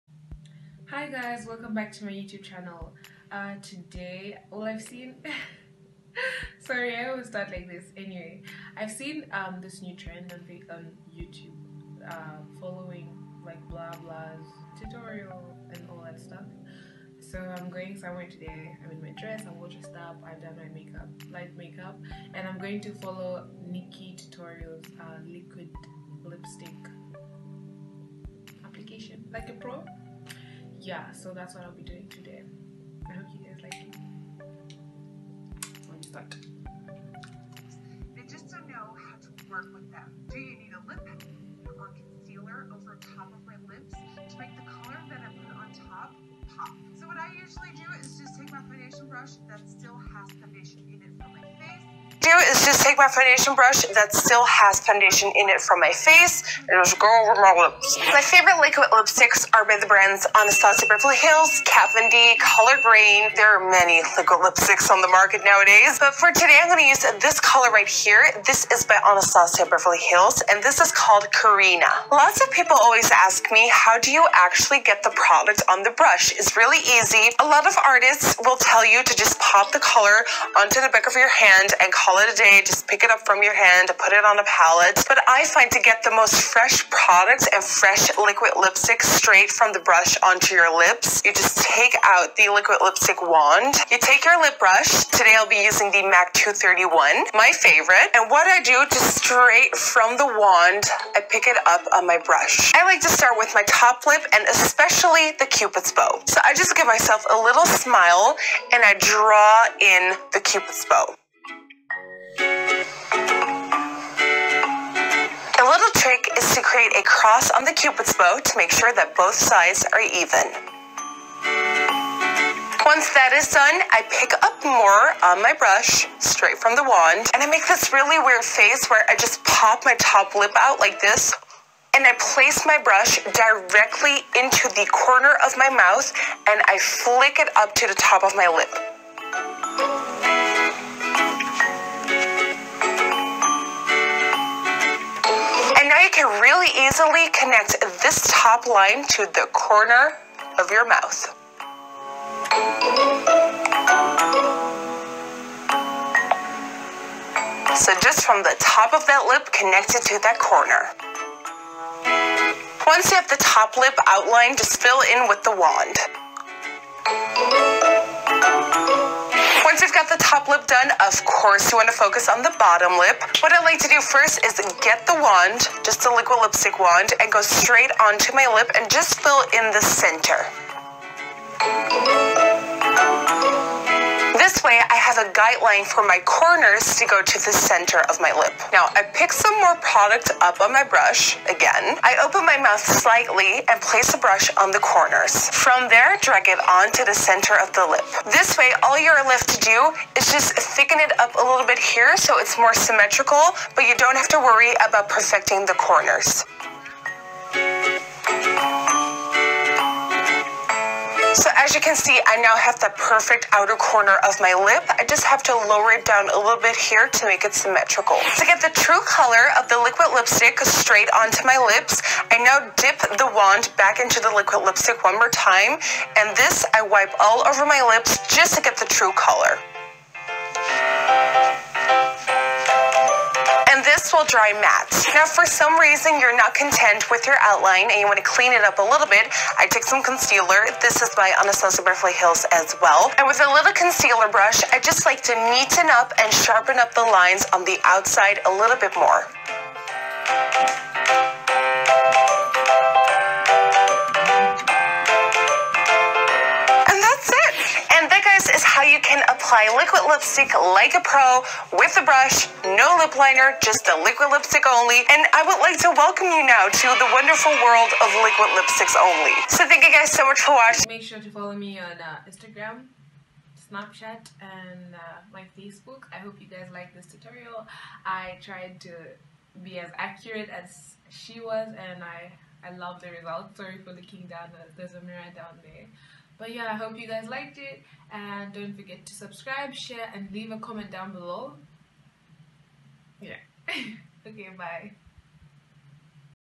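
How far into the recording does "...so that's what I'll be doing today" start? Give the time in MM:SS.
00:31.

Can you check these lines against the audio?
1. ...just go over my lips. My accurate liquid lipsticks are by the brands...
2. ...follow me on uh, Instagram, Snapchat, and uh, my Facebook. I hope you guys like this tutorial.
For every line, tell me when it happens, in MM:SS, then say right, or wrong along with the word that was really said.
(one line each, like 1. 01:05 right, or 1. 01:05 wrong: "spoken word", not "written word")
1. 00:56 wrong: "favorite", not "accurate"
2. 04:31 right.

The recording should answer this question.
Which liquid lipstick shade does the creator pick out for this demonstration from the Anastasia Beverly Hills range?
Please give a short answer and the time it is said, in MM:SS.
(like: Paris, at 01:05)
Karina, at 01:11.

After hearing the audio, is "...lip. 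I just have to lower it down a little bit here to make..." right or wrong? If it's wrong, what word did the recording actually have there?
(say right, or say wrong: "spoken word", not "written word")
right.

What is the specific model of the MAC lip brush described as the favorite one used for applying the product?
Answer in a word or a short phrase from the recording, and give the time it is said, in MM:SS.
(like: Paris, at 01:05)
231, at 01:36.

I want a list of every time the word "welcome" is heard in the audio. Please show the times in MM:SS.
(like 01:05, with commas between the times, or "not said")
00:01, 04:25.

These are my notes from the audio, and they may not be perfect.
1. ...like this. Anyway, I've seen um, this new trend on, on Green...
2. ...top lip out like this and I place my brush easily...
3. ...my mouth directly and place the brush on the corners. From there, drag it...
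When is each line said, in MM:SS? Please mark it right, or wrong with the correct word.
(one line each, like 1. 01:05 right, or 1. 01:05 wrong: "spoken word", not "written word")
1. 00:07 wrong: "YouTube", not "Green"
2. 02:10 wrong: "directly", not "easily"
3. 03:12 wrong: "slightly", not "directly".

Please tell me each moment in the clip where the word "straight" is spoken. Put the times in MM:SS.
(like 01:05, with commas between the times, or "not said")
01:29, 01:39, 02:06, 02:57, 03:40.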